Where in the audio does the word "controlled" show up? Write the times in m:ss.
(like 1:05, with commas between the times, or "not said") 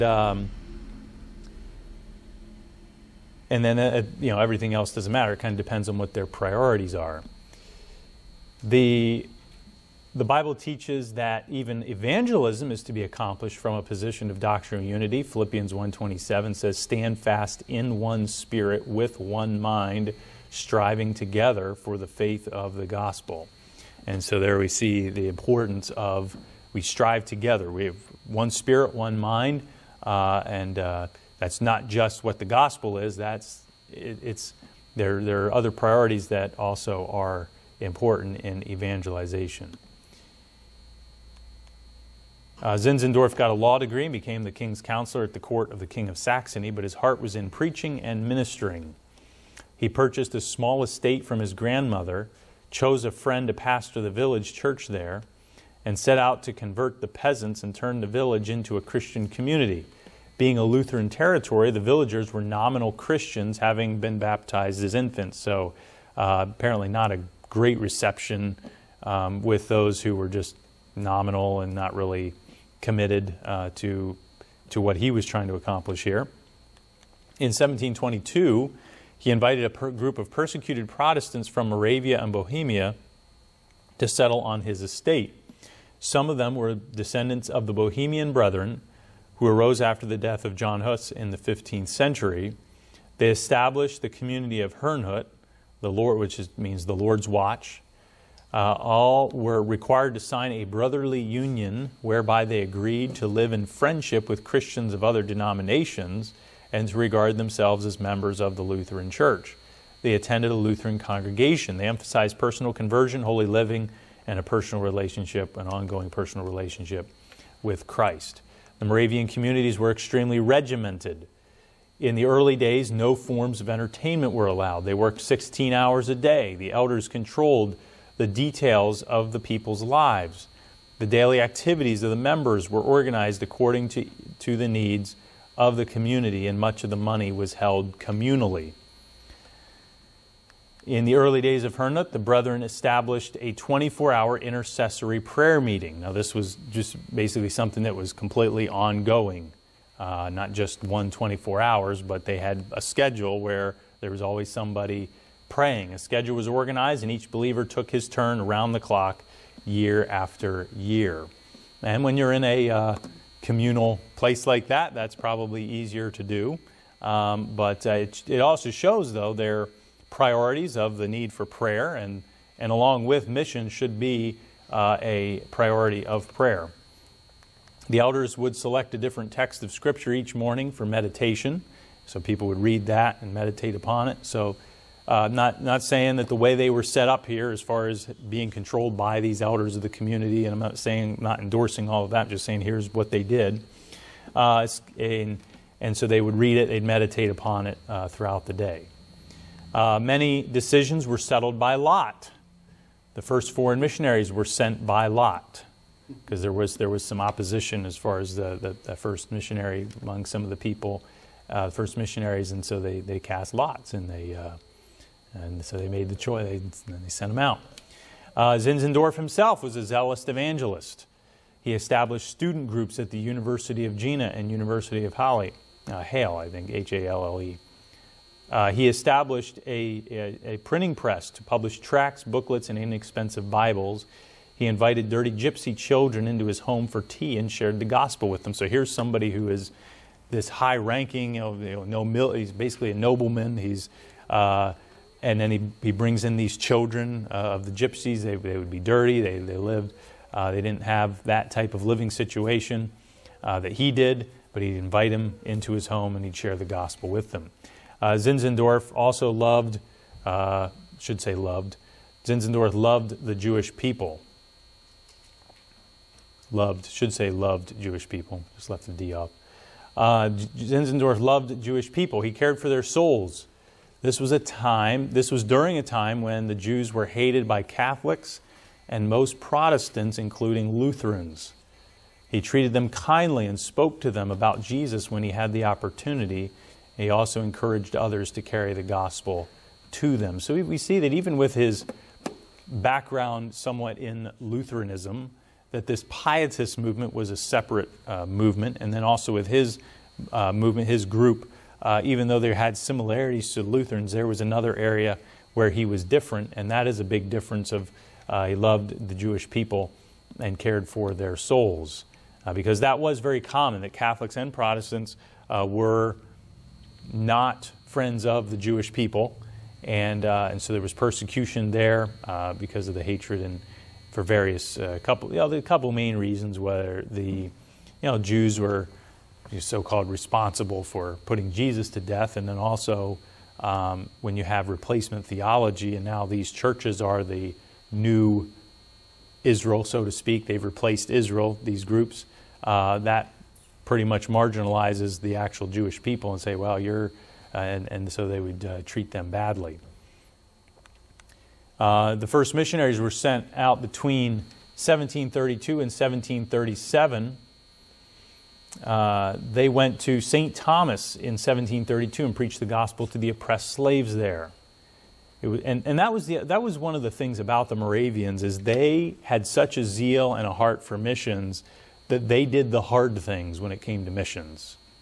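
2:07, 3:08.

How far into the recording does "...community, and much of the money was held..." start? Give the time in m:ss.
2:15.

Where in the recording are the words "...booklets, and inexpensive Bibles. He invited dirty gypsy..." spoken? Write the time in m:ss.
3:52.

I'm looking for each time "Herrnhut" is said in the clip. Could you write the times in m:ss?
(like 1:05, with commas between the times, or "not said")
1:34, 2:21.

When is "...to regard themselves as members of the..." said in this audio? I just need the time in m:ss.
1:46.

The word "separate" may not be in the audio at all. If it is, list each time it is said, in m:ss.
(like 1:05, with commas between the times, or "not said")
4:57.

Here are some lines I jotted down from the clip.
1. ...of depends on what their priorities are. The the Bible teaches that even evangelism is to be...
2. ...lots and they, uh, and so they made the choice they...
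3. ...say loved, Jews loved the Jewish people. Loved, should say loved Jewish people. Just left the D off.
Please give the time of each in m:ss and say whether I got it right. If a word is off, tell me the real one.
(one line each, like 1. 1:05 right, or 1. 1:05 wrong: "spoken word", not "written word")
1. 0:05 right
2. 3:33 right
3. 4:21 wrong: "Zinzendorf", not "Jews".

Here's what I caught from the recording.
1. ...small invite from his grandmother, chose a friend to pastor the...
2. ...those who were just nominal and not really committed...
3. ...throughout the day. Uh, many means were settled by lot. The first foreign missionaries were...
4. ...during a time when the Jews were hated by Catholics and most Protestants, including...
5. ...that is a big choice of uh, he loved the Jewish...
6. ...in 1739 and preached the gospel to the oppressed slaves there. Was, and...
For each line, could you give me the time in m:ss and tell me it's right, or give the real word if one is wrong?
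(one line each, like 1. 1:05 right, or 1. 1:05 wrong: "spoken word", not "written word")
1. 0:50 wrong: "estate", not "invite"
2. 1:09 right
3. 3:18 wrong: "decisions", not "means"
4. 4:35 right
5. 5:06 wrong: "difference", not "choice"
6. 6:01 wrong: "1732", not "1739".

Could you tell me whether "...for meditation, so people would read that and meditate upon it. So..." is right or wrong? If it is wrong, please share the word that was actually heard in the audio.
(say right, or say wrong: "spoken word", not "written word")
right.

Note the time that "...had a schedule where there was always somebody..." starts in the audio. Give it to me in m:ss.
2:32.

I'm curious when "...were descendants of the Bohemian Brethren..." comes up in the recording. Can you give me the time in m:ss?
1:26.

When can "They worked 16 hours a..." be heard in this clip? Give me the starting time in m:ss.
2:04.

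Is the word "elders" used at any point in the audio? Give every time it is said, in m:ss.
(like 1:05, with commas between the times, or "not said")
2:06, 2:57, 3:09.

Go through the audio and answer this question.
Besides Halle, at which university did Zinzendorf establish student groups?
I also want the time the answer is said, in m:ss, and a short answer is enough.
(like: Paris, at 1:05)
University of Jena, at 3:43.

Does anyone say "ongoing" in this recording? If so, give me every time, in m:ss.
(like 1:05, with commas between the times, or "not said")
1:55, 2:28.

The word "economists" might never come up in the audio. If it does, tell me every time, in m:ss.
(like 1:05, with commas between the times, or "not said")
not said.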